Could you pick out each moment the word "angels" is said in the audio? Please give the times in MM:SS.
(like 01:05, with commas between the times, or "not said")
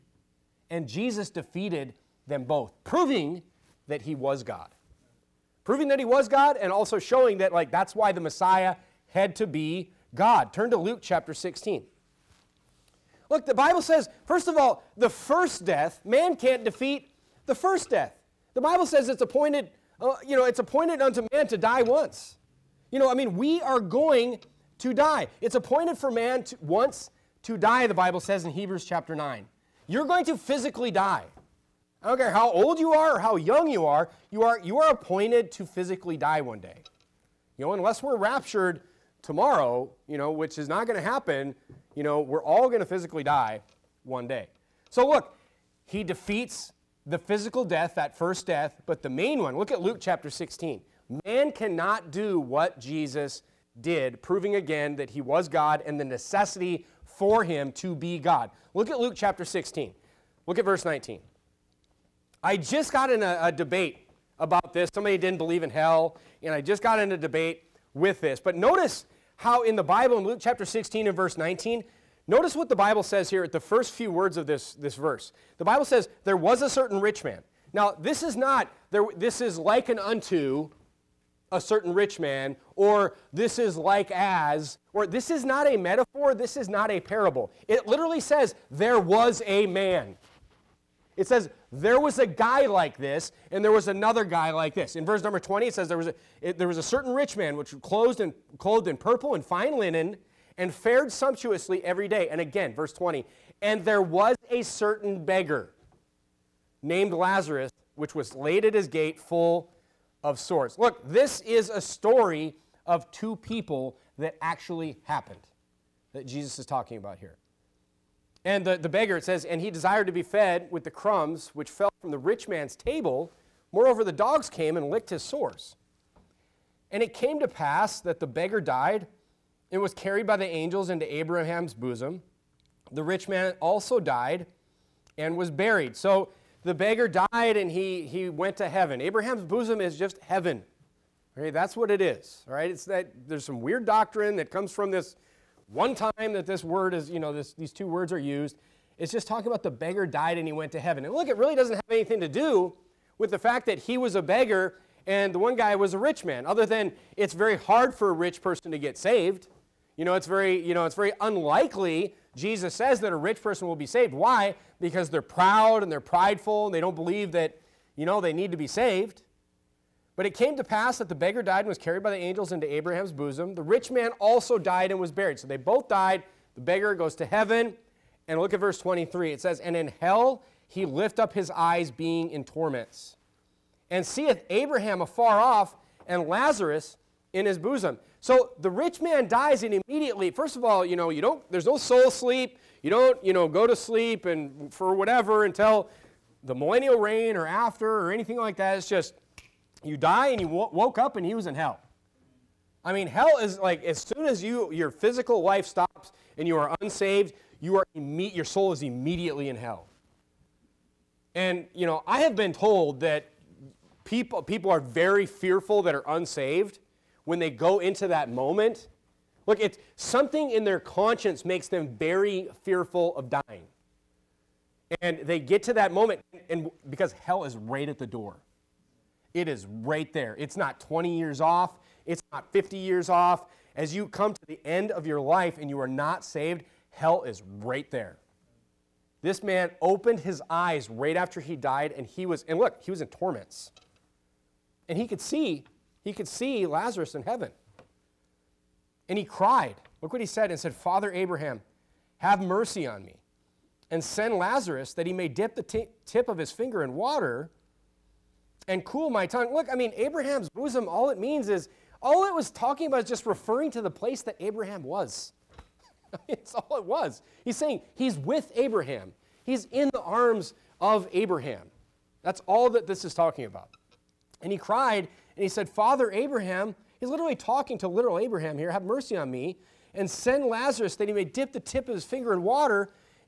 02:10, 02:52.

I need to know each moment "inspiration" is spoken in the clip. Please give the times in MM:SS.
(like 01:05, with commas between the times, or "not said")
not said.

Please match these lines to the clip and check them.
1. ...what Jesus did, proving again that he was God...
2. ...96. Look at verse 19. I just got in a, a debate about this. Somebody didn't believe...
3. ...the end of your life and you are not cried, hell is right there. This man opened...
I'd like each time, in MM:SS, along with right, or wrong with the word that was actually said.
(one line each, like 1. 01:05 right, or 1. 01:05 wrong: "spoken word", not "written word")
1. 00:52 right
2. 00:59 wrong: "16", not "96"
3. 03:54 wrong: "saved", not "cried".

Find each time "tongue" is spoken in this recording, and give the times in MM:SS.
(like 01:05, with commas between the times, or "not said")
04:19.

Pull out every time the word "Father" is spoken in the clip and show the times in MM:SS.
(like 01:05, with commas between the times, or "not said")
04:10, 04:35.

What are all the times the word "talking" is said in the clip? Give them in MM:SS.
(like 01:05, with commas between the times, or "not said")
01:56, 02:29, 04:22, 04:33, 04:37.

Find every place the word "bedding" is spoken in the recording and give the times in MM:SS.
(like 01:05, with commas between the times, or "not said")
not said.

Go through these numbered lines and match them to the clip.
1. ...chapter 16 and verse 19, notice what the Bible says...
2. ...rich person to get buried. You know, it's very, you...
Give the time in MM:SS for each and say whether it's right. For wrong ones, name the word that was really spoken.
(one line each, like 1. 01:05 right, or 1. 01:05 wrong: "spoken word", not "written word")
1. 01:10 right
2. 02:38 wrong: "saved", not "buried".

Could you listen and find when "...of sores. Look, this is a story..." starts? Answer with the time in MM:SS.
01:50.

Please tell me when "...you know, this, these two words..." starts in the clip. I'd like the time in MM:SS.
02:27.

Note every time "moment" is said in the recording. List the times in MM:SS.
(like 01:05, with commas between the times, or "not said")
03:38, 03:45.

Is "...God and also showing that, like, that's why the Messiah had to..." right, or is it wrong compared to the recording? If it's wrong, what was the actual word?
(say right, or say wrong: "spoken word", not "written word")
right.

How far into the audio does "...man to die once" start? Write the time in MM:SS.
00:21.